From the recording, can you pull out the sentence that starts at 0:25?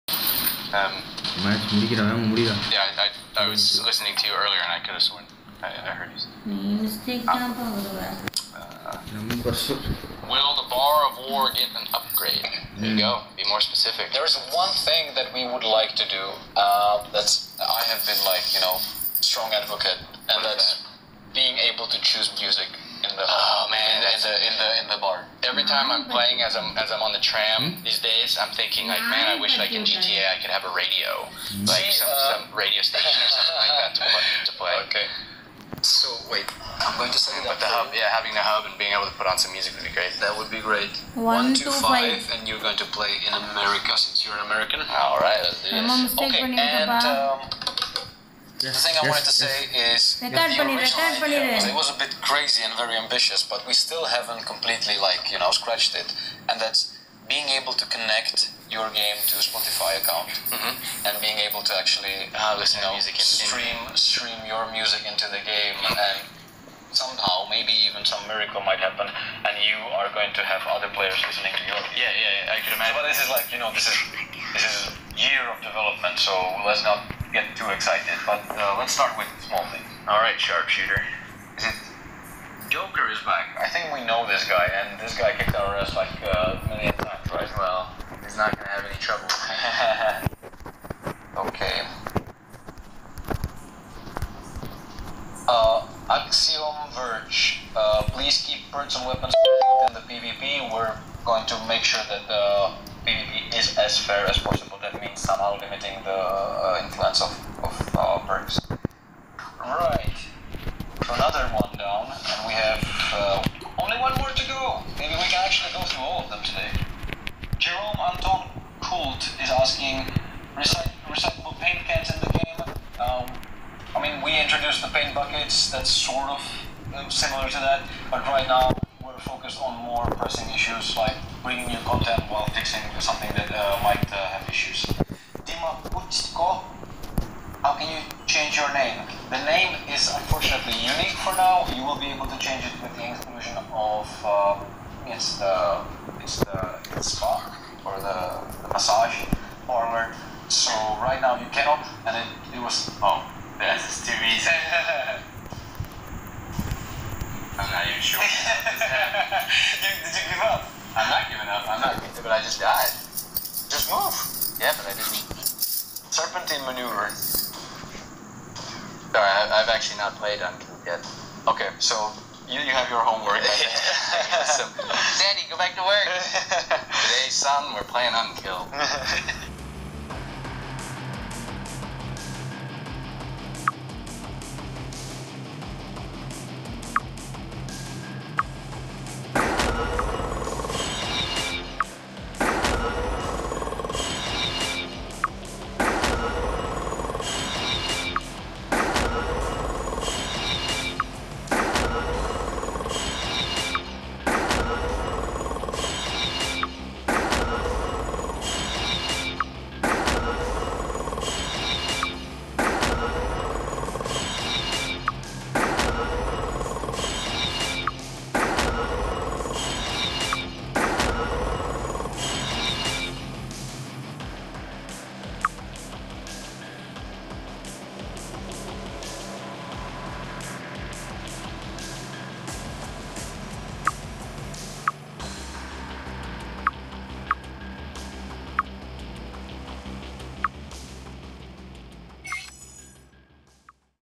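Every time I'm playing, as I'm as I'm on the tram hmm?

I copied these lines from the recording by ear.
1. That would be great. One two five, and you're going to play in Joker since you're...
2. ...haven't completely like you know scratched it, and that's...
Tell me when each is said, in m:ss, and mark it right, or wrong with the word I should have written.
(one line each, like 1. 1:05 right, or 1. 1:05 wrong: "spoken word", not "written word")
1. 0:40 wrong: "America", not "Joker"
2. 0:54 right.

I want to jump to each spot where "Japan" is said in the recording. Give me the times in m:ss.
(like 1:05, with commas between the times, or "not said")
not said.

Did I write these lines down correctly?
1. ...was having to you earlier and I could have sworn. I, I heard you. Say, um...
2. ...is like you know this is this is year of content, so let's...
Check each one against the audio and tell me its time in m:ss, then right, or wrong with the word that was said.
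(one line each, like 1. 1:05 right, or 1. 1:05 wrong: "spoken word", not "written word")
1. 0:03 wrong: "listening", not "having"
2. 1:13 wrong: "development", not "content".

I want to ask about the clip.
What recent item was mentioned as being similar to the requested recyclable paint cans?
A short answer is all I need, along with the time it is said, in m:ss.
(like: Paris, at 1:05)
paint buckets, at 2:04.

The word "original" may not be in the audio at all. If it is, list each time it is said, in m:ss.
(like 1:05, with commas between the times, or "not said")
0:50.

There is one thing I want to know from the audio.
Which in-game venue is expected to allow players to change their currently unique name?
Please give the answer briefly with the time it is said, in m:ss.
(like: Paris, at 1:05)
massage parlor, at 2:28.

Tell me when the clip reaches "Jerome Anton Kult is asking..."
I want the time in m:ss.
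1:57.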